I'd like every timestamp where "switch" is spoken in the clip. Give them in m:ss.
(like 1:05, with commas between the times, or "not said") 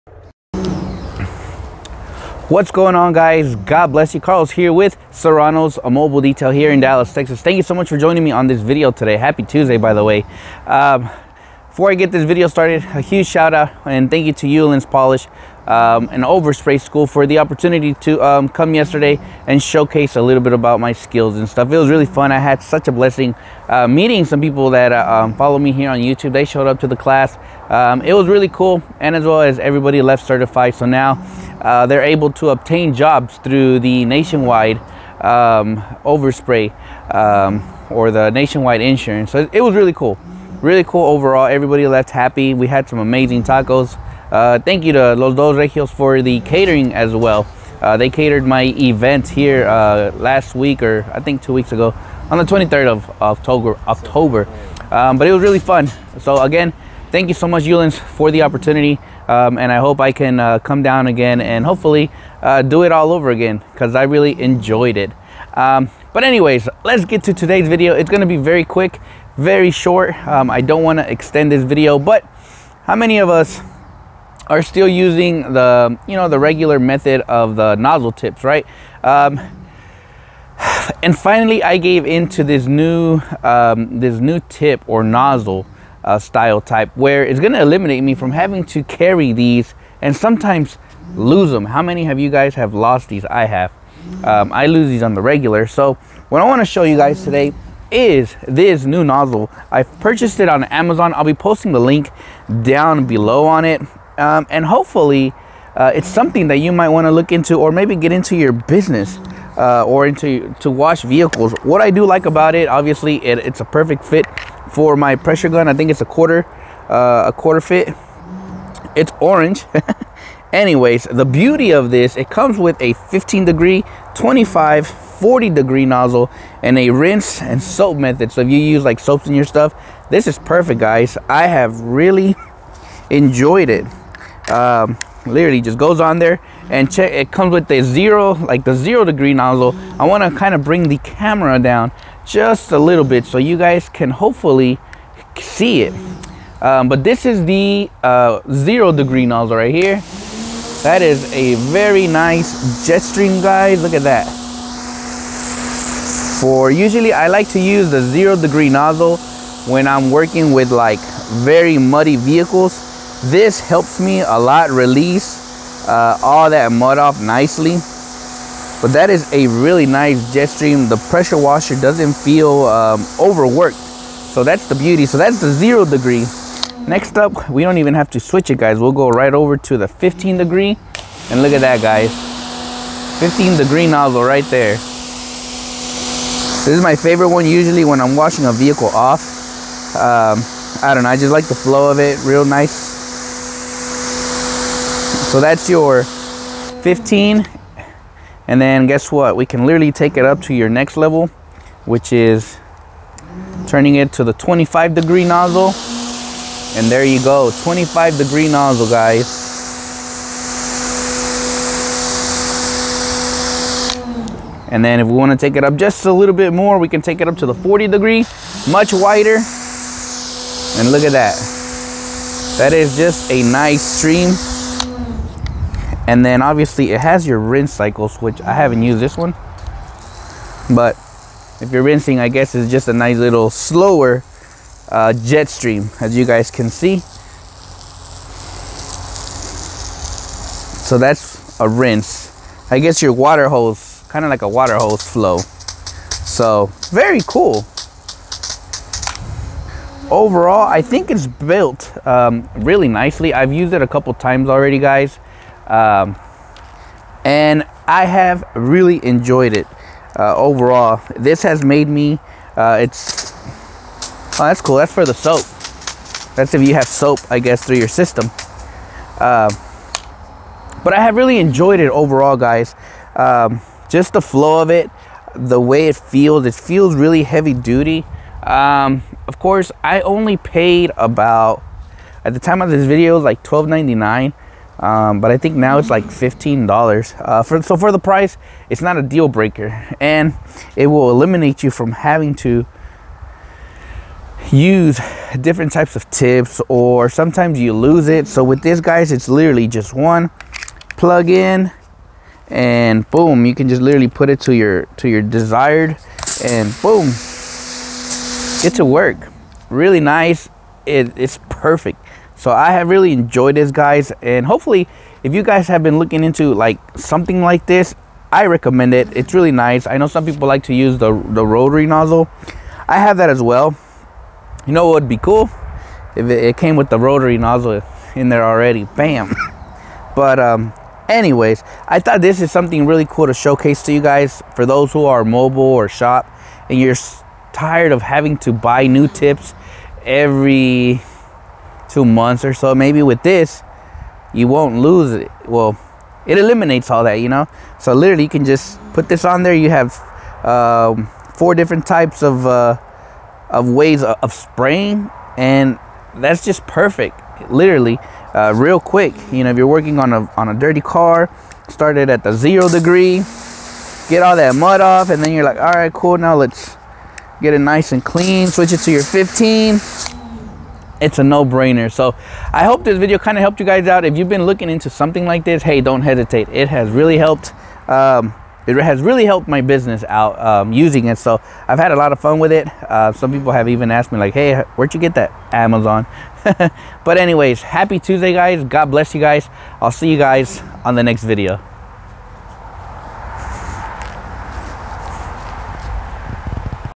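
2:58, 6:08.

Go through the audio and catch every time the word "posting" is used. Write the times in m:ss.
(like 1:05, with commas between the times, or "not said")
1:41.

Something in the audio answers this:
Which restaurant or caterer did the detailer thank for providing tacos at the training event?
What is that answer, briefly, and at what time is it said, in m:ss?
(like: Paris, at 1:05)
Los Dos Regios, at 0:45.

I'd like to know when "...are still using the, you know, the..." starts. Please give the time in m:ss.
1:14.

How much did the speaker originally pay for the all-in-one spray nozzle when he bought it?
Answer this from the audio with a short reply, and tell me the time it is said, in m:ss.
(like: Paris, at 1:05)
$12.99, at 4:43.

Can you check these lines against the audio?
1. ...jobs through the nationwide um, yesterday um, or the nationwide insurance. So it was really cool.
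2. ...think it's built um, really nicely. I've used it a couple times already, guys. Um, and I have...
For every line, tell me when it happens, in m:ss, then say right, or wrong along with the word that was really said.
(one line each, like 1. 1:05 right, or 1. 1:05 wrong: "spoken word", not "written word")
1. 0:32 wrong: "overspray", not "yesterday"
2. 4:10 right.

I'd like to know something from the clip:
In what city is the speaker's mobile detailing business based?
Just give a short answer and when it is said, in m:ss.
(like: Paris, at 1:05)
Dallas, at 0:06.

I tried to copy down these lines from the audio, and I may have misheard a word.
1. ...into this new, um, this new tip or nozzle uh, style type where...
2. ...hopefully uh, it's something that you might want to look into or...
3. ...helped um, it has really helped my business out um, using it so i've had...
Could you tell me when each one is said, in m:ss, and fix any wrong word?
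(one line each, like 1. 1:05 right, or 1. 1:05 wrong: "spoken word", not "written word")
1. 1:22 right
2. 1:44 right
3. 6:17 right.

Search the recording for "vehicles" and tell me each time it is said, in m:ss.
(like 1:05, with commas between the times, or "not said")
1:51, 2:42, 3:08.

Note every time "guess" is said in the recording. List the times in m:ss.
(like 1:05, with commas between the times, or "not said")
3:18, 3:52, 4:02, 4:27.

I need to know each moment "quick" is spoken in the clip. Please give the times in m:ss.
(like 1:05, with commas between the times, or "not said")
1:08, 5:58.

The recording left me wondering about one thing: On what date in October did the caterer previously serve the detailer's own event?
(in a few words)
October 23.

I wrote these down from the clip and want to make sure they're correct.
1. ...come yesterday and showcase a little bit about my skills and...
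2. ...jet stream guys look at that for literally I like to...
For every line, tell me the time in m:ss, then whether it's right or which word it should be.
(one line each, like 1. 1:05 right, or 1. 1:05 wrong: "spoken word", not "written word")
1. 0:18 right
2. 2:32 wrong: "usually", not "literally".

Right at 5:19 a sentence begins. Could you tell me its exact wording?
I know some people like to use the, the rotary nozzle.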